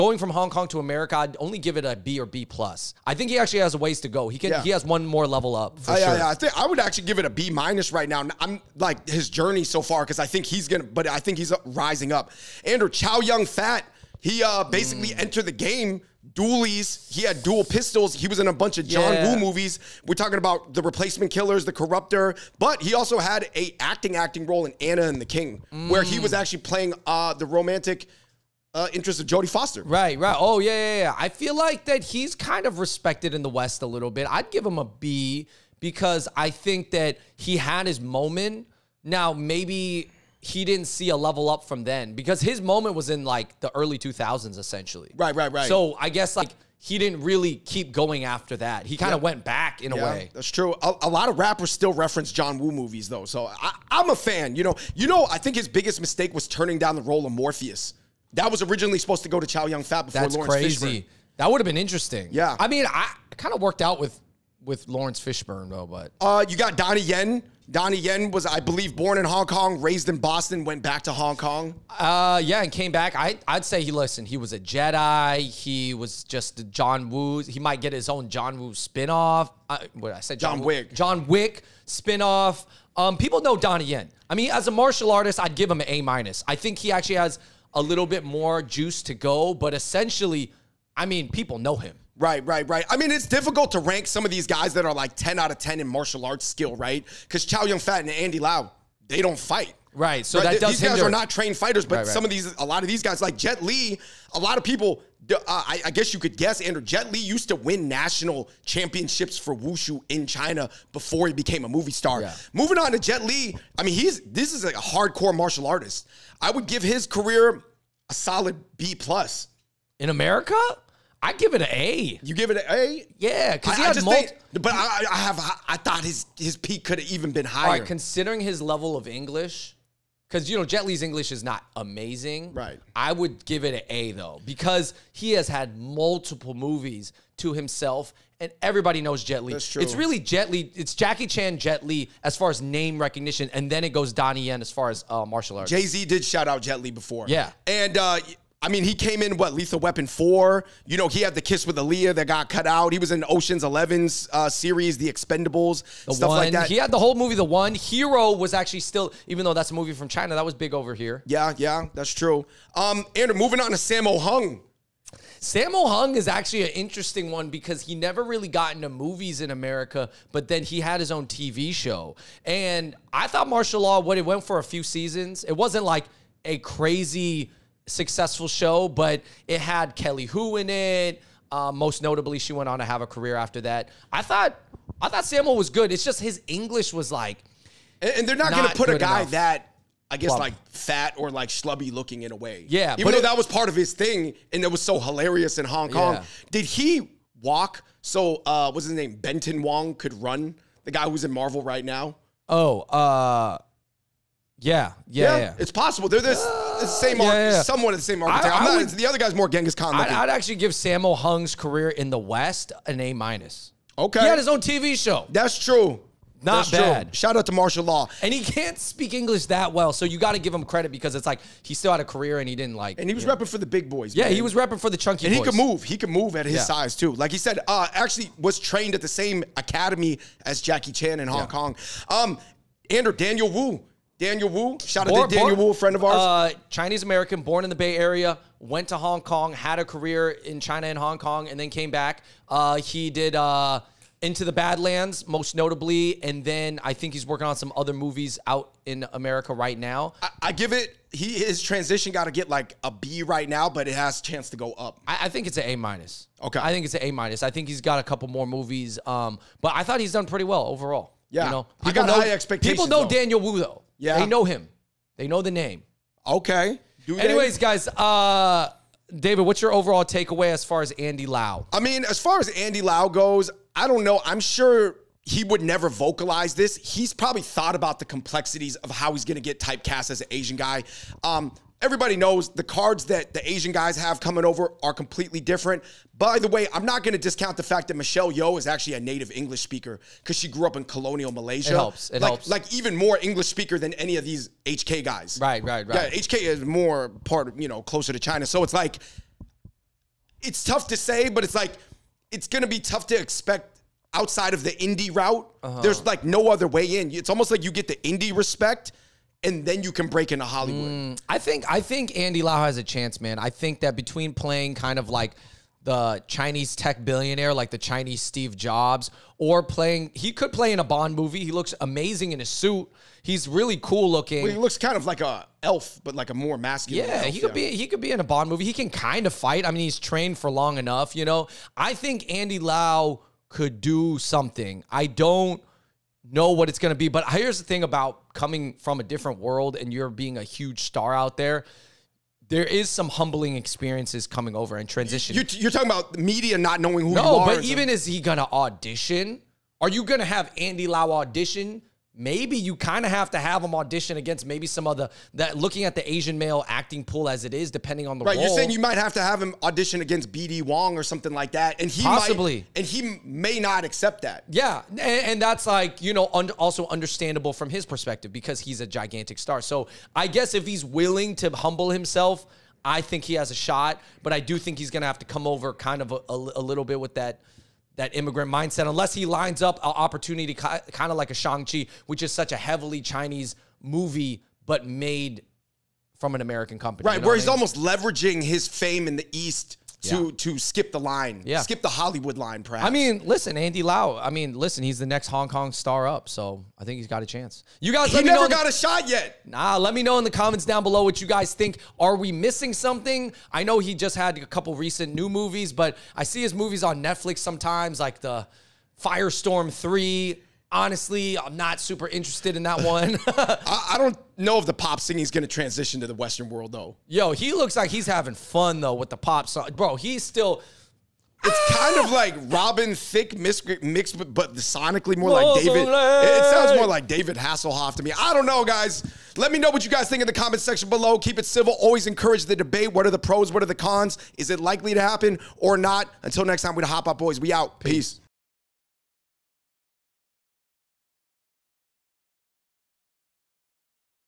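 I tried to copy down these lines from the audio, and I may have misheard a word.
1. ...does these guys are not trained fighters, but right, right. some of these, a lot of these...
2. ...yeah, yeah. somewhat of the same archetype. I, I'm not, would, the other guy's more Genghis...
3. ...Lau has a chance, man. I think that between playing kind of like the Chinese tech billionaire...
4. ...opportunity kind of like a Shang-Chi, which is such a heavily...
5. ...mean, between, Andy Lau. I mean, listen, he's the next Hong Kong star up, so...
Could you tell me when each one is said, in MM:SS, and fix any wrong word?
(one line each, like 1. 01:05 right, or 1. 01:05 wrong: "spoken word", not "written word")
1. 01:40 right
2. 03:27 right
3. 05:12 right
4. 06:19 right
5. 06:32 wrong: "listen", not "between".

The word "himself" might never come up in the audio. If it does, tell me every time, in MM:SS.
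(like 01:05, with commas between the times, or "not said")
02:17, 06:11.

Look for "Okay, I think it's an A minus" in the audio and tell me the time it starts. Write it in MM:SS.
04:16.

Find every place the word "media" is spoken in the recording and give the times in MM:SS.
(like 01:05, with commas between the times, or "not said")
05:46.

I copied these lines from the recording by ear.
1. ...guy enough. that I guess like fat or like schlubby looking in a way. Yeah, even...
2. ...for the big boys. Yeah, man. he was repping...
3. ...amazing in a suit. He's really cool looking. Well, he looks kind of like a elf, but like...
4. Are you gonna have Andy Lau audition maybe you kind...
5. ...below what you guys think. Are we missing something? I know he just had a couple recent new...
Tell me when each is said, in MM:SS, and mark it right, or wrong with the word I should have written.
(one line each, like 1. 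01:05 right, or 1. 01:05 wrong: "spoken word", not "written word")
1. 03:08 right
2. 03:43 right
3. 05:21 right
4. 05:49 right
5. 06:40 right.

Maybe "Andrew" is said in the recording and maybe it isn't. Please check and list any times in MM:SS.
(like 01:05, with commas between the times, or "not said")
00:12, 01:46.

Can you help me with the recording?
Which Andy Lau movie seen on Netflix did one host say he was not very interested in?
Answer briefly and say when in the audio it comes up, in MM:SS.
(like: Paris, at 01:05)
Firestorm 3, at 06:49.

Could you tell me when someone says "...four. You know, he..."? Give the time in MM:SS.
02:30.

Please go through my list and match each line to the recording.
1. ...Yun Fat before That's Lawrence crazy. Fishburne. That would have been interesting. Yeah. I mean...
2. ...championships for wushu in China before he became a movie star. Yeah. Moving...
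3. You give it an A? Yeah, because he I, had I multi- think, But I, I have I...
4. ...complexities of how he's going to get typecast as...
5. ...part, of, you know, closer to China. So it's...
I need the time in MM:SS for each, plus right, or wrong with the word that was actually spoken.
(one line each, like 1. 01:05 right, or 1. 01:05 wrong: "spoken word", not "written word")
1. 00:59 right
2. 01:48 right
3. 02:02 right
4. 04:38 right
5. 04:57 right.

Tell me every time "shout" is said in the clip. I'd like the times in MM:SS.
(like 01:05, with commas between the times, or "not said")
02:26, 03:37, 03:54.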